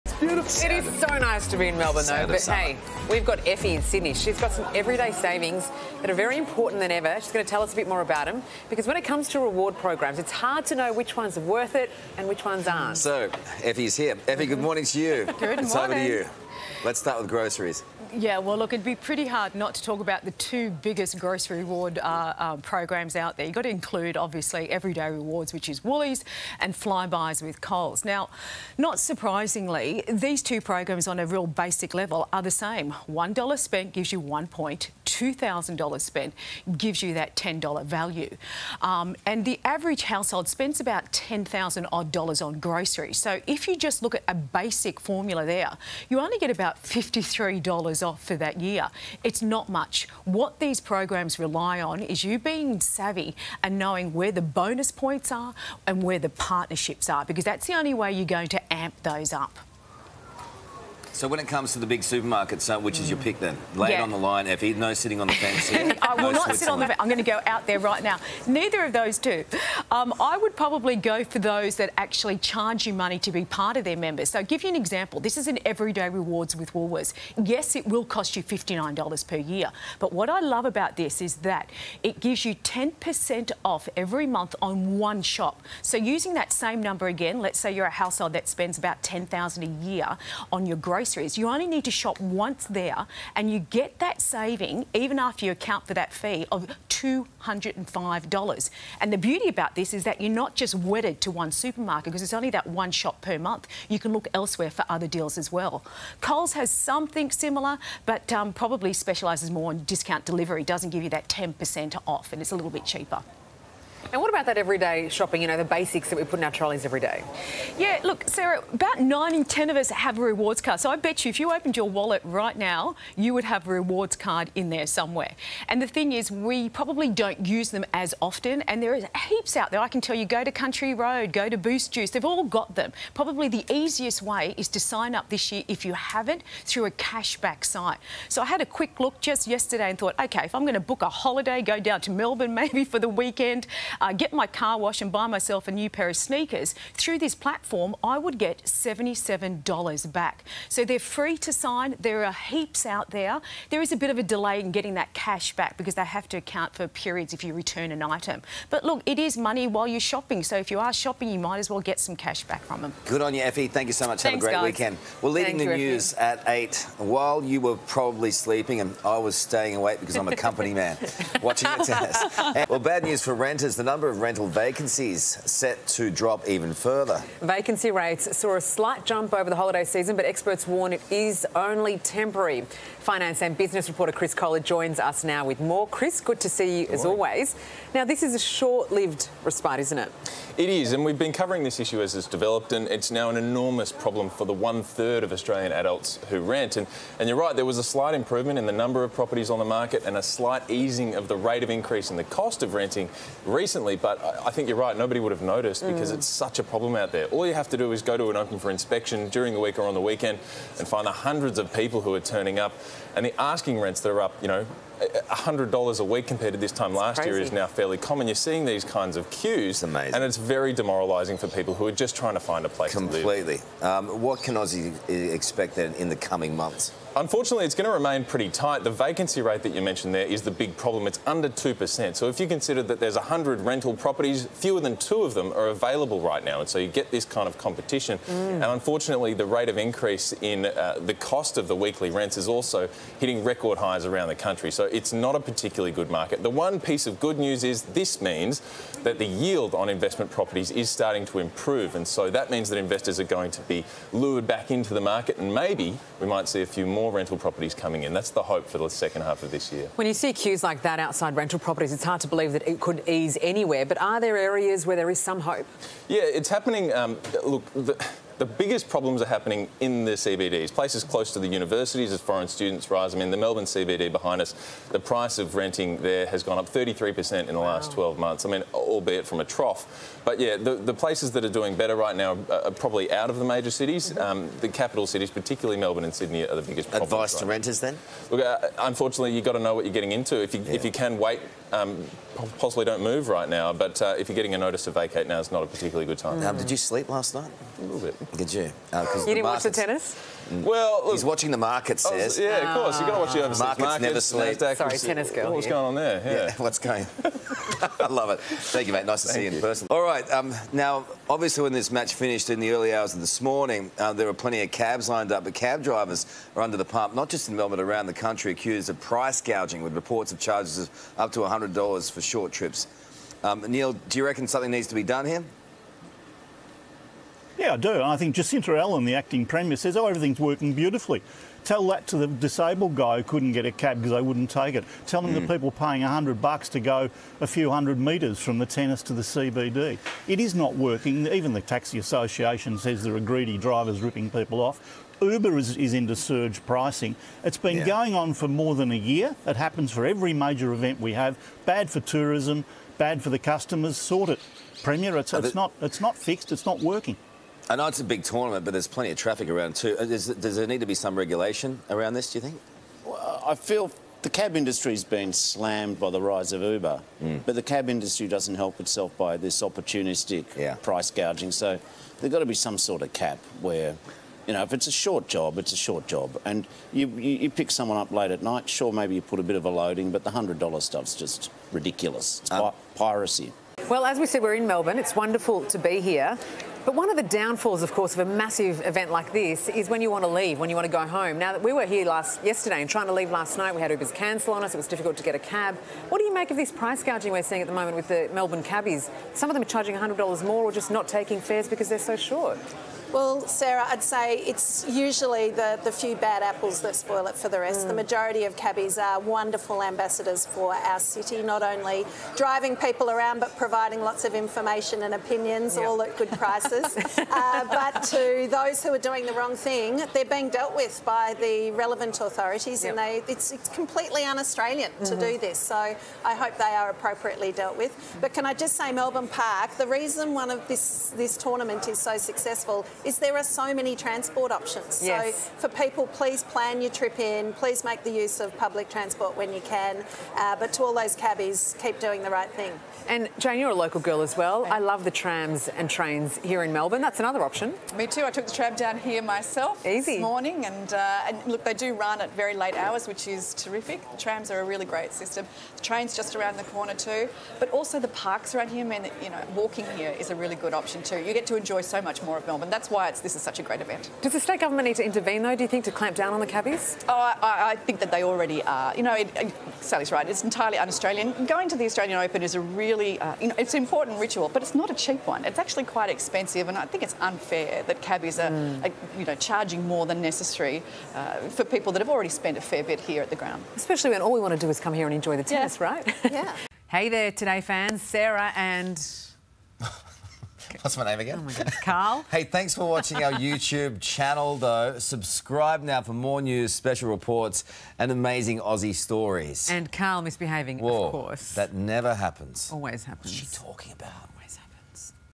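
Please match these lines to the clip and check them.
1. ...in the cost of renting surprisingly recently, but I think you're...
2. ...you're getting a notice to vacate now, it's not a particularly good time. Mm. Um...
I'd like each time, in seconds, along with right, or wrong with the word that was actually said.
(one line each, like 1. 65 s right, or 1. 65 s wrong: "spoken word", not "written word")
1. 202 s wrong: "recently", not "surprisingly"
2. 294 s right.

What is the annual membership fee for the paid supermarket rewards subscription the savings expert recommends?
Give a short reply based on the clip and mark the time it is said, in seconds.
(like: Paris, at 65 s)
$59, at 78 s.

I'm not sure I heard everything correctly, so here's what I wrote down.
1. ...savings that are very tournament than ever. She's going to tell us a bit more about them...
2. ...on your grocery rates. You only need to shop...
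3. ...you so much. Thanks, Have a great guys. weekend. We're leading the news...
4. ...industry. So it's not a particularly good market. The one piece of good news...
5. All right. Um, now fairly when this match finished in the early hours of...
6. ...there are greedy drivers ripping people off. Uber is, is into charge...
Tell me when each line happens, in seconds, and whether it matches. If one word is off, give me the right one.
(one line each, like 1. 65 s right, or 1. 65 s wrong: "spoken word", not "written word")
1. 5 s wrong: "important", not "tournament"
2. 90 s wrong: "groceries", not "rates"
3. 163 s right
4. 244 s wrong: "country", not "industry"
5. 309 s wrong: "obviously", not "fairly"
6. 343 s wrong: "surge", not "charge".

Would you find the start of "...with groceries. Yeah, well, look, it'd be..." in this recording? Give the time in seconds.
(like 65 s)
17 s.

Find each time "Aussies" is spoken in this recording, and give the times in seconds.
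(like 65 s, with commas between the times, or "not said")
224 s, 498 s.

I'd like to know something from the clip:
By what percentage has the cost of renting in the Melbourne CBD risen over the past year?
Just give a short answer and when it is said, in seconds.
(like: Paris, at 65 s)
33%, at 276 s.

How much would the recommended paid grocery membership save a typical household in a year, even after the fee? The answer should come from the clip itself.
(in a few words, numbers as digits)
$205.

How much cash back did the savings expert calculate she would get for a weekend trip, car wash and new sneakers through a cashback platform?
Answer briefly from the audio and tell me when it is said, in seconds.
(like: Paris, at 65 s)
$77, at 148 s.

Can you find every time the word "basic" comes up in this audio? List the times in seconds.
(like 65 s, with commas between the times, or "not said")
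31 s, 44 s, 115 s.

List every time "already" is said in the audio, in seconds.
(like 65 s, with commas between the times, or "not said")
468 s, 482 s.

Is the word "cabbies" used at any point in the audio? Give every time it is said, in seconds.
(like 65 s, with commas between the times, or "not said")
398 s, 408 s, 441 s, 466 s, 478 s.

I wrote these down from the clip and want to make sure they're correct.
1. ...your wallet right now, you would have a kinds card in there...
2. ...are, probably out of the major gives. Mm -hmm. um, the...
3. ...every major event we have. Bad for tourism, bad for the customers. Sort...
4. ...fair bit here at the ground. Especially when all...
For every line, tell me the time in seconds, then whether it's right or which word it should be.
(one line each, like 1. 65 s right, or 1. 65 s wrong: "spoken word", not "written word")
1. 121 s wrong: "rewards", not "kinds"
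2. 282 s wrong: "cities", not "gives"
3. 350 s right
4. 482 s right.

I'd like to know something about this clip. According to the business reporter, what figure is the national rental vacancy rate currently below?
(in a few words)
2%.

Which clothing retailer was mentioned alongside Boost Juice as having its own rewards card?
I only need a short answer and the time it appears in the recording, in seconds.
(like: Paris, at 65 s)
Country Road, at 130 s.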